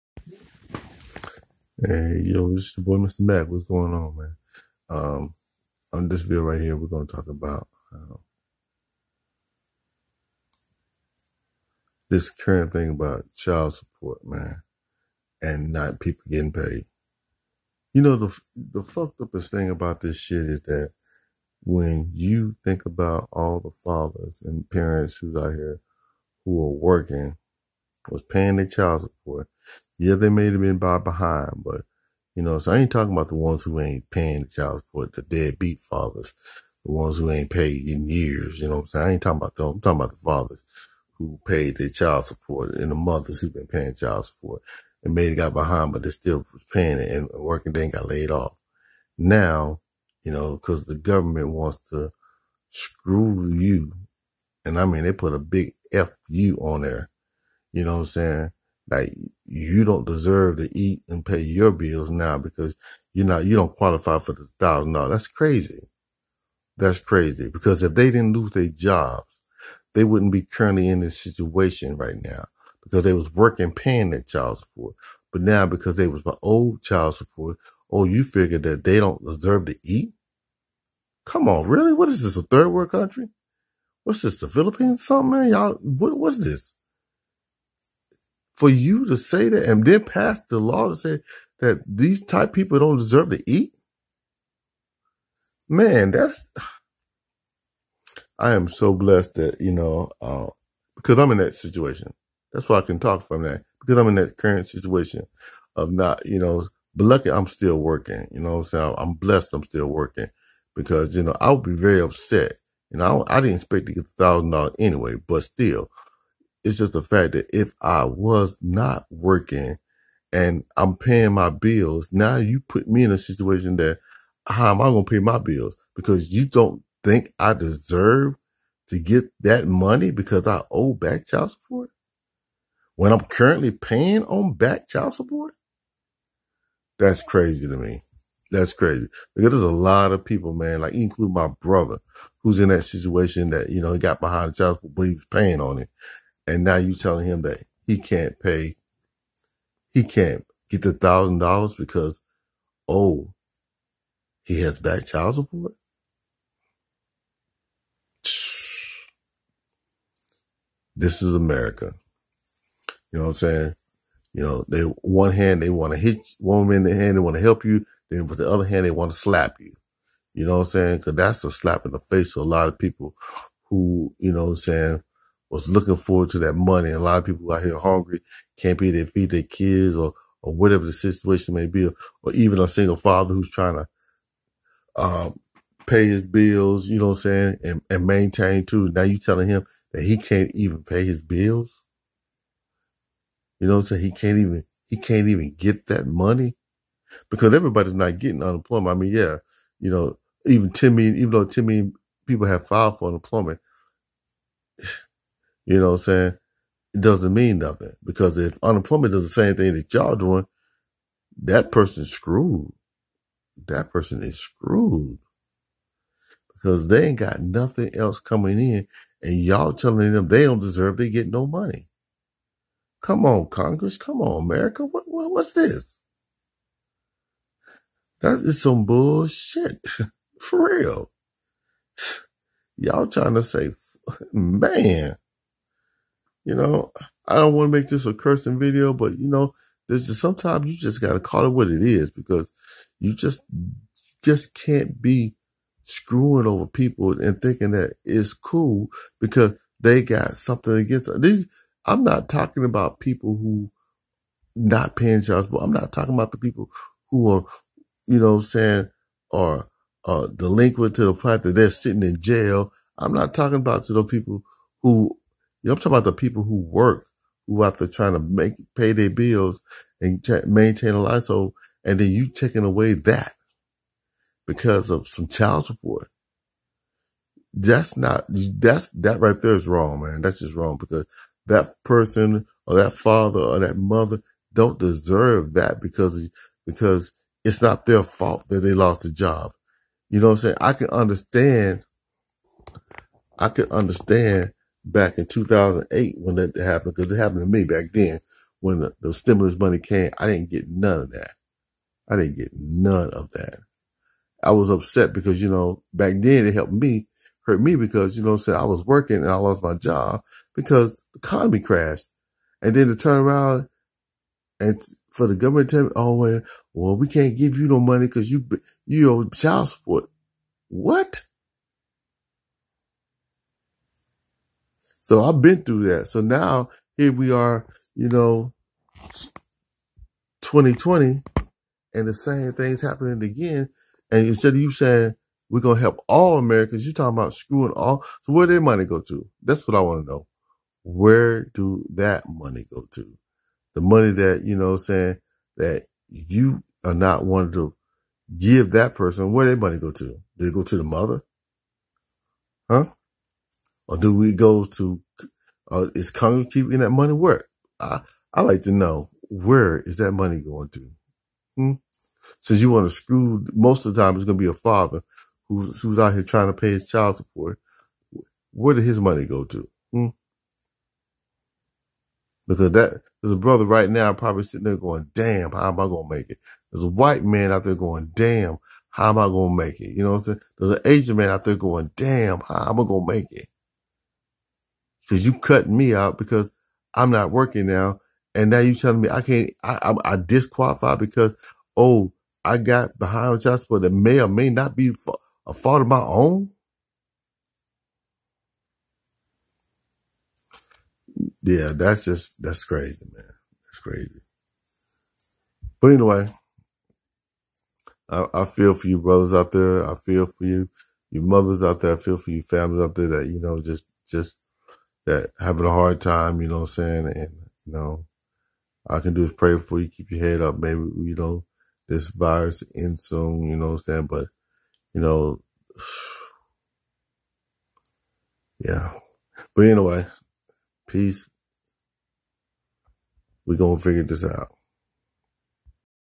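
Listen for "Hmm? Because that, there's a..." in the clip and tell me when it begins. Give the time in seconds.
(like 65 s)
369 s.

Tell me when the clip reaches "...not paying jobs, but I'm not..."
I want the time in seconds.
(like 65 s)
254 s.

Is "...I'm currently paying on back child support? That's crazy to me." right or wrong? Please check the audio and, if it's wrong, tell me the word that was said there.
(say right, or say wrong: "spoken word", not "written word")
right.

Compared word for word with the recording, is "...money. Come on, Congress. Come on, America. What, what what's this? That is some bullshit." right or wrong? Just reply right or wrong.
right.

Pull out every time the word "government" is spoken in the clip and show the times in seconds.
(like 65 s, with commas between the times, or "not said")
50 s, 315 s.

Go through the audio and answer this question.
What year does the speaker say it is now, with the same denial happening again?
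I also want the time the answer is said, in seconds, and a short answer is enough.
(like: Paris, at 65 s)
2020, at 330 s.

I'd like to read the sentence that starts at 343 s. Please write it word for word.
The money that, you know, saying that you are not wanting to give that person, where their money go to?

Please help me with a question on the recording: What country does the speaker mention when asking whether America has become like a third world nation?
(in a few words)
The Philippines.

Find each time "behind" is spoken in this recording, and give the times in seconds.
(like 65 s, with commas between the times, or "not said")
30 s, 45 s, 144 s, 392 s.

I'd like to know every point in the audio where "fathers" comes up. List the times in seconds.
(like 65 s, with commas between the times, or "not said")
23 s, 35 s, 40 s, 182 s, 282 s, 364 s.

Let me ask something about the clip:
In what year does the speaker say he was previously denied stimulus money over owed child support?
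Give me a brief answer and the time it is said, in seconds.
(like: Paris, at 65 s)
2008, at 295 s.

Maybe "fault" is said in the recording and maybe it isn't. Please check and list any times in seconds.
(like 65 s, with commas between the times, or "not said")
288 s, 395 s.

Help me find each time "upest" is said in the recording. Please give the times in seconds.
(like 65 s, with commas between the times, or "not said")
19 s.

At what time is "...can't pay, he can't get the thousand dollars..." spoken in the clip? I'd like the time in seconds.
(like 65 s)
147 s.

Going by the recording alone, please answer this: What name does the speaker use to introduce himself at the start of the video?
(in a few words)
Mr. Mack.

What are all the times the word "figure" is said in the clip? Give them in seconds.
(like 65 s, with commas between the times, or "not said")
78 s, 433 s.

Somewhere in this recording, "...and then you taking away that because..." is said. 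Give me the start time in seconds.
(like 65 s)
271 s.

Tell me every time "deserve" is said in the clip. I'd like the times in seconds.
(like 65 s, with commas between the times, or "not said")
60 s, 79 s, 92 s, 127 s, 220 s, 284 s.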